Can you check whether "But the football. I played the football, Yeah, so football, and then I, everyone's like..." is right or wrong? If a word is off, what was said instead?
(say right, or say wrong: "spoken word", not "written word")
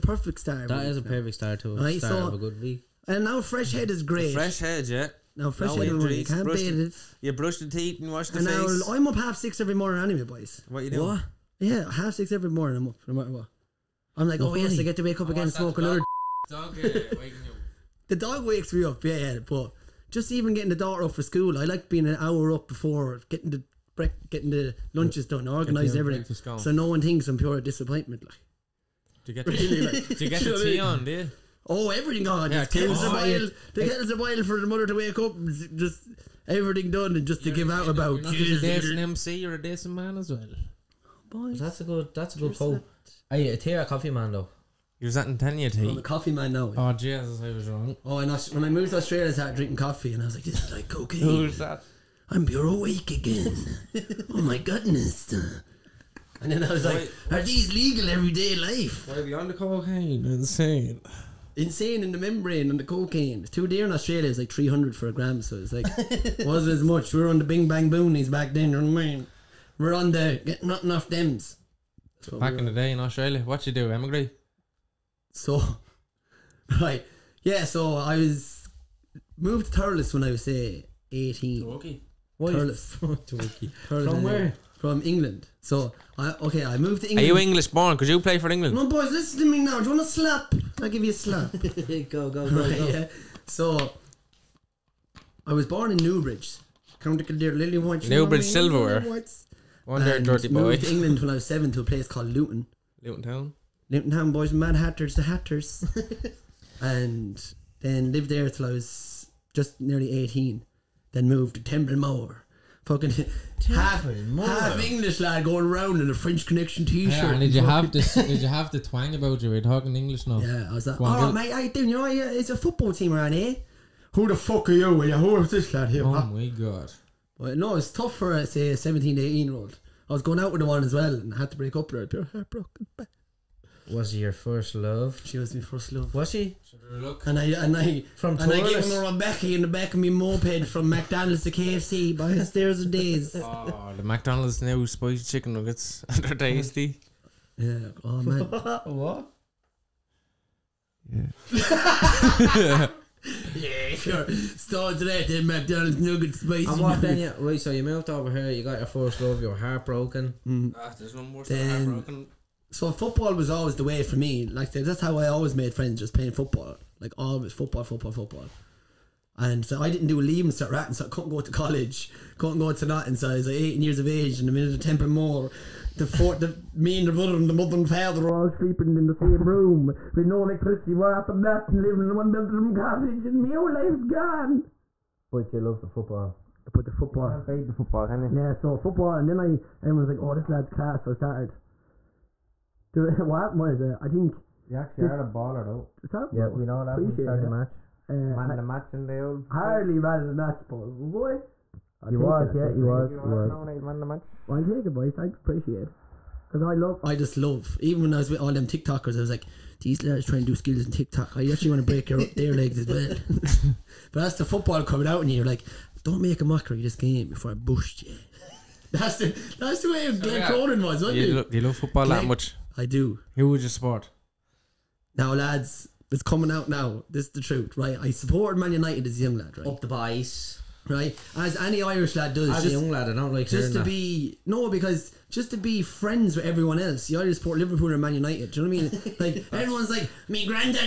right.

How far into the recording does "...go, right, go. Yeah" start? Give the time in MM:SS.
01:32.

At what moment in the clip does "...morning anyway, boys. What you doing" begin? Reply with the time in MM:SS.
00:09.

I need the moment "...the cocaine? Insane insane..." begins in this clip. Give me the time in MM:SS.
00:59.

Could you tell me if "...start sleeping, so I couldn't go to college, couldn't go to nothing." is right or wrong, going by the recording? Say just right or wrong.
wrong.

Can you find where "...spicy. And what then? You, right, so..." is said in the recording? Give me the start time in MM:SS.
02:36.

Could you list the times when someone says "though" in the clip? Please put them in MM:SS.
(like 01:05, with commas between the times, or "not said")
00:44, 03:15.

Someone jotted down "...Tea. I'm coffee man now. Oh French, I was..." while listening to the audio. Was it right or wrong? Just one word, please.
wrong.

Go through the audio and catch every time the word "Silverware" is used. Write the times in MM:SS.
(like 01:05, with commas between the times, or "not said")
01:38.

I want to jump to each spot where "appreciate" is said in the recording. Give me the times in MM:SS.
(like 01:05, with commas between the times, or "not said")
03:16, 03:25.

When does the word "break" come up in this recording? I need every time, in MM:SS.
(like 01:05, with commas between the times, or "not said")
00:23, 02:11, 03:31.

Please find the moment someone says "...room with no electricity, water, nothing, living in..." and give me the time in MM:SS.
02:59.